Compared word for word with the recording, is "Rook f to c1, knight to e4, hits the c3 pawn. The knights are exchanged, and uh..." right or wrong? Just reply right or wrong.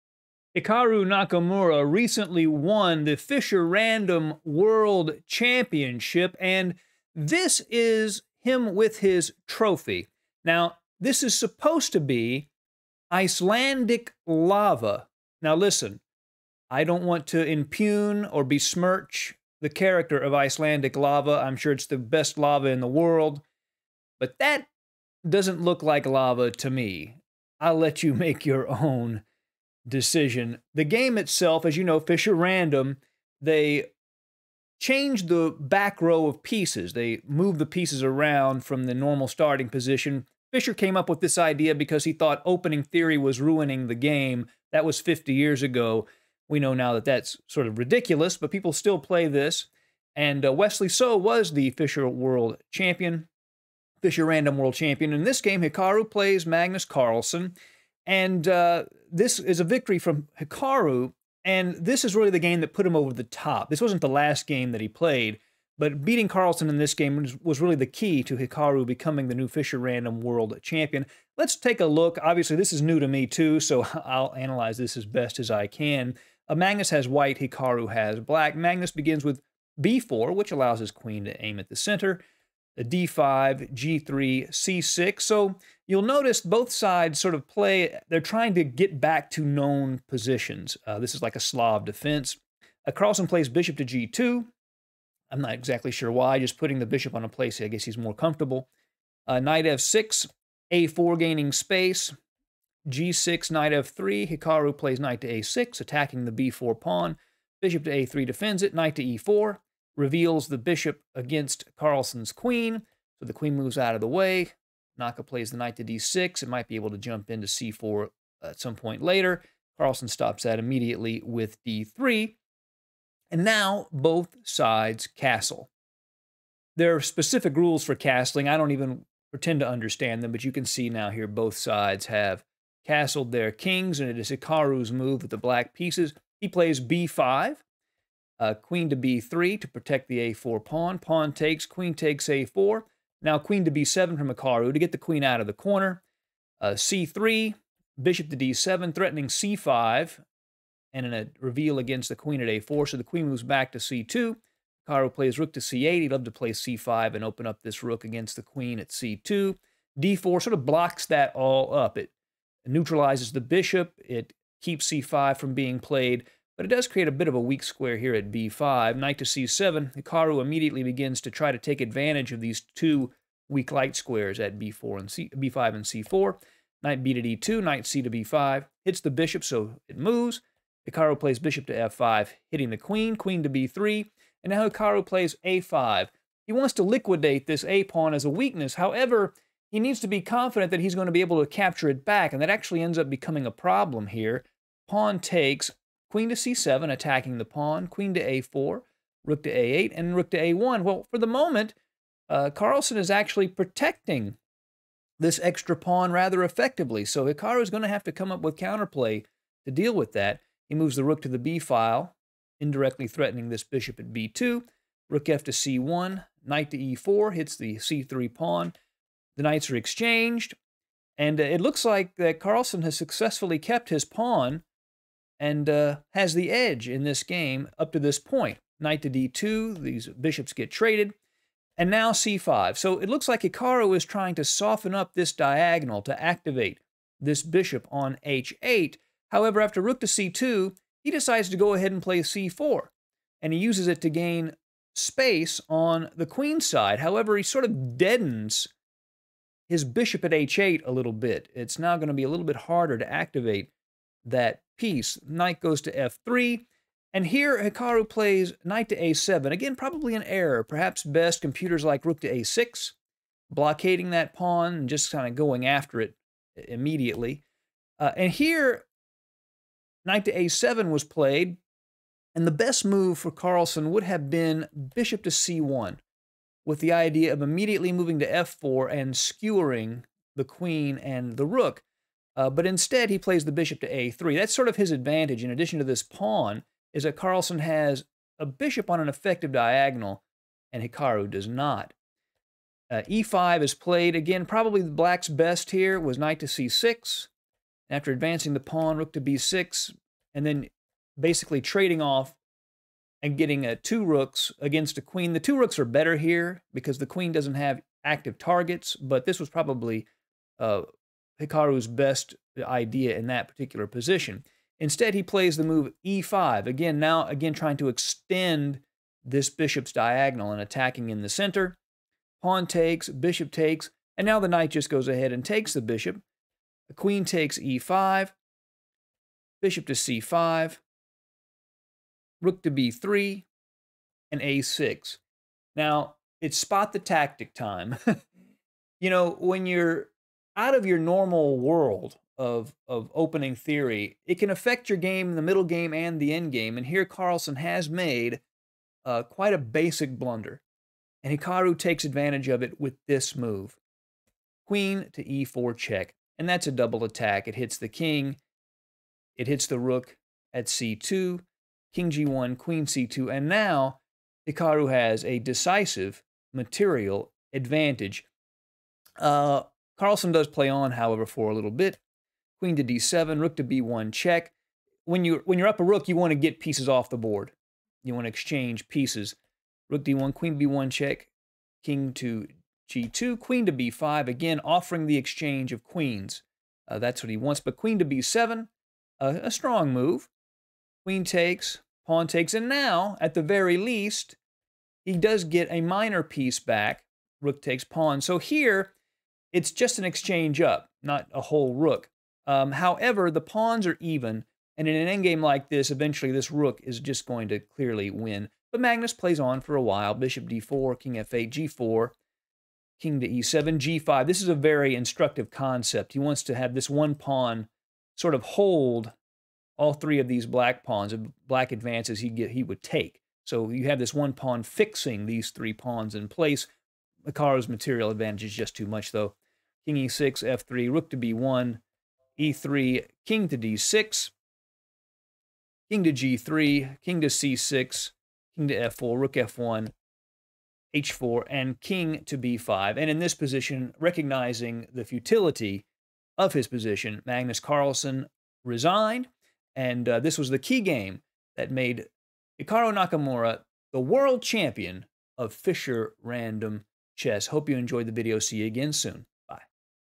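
right.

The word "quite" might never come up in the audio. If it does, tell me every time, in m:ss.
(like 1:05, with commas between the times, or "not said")
5:49.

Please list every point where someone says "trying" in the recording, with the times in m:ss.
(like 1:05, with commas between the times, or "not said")
1:28, 3:54, 5:17.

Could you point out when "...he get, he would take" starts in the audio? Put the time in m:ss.
7:02.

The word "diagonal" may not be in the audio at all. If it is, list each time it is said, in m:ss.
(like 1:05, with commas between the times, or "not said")
3:55, 4:49, 5:19.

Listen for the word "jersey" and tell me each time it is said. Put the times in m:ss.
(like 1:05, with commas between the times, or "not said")
not said.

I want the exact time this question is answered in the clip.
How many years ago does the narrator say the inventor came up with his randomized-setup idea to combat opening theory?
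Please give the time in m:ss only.
0:44.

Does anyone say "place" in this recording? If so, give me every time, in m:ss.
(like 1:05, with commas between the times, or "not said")
1:37, 7:06.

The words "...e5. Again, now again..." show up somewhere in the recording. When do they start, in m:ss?
5:16.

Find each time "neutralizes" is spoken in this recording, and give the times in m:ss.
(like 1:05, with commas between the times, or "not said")
2:42.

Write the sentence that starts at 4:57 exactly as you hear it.
After advancing the pawn, rook to b6, and then basically trading off and getting uh, two rooks against a queen.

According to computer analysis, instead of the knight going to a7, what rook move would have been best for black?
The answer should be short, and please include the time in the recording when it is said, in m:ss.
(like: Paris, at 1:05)
Rook to a6, at 4:22.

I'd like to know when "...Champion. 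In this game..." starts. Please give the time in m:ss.
0:54.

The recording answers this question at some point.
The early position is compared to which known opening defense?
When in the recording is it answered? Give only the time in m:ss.
1:31.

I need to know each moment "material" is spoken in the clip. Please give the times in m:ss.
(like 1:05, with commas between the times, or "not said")
6:06, 7:07.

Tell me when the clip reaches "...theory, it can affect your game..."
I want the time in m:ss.
5:43.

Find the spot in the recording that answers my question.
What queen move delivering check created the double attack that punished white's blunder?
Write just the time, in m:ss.
5:54.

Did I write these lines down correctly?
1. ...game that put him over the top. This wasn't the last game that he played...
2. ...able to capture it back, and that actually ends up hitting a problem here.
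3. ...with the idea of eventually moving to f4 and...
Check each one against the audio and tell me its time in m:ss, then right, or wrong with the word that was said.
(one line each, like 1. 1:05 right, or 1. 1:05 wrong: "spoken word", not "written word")
1. 1:02 right
2. 3:11 wrong: "becoming", not "hitting"
3. 4:36 wrong: "immediately", not "eventually".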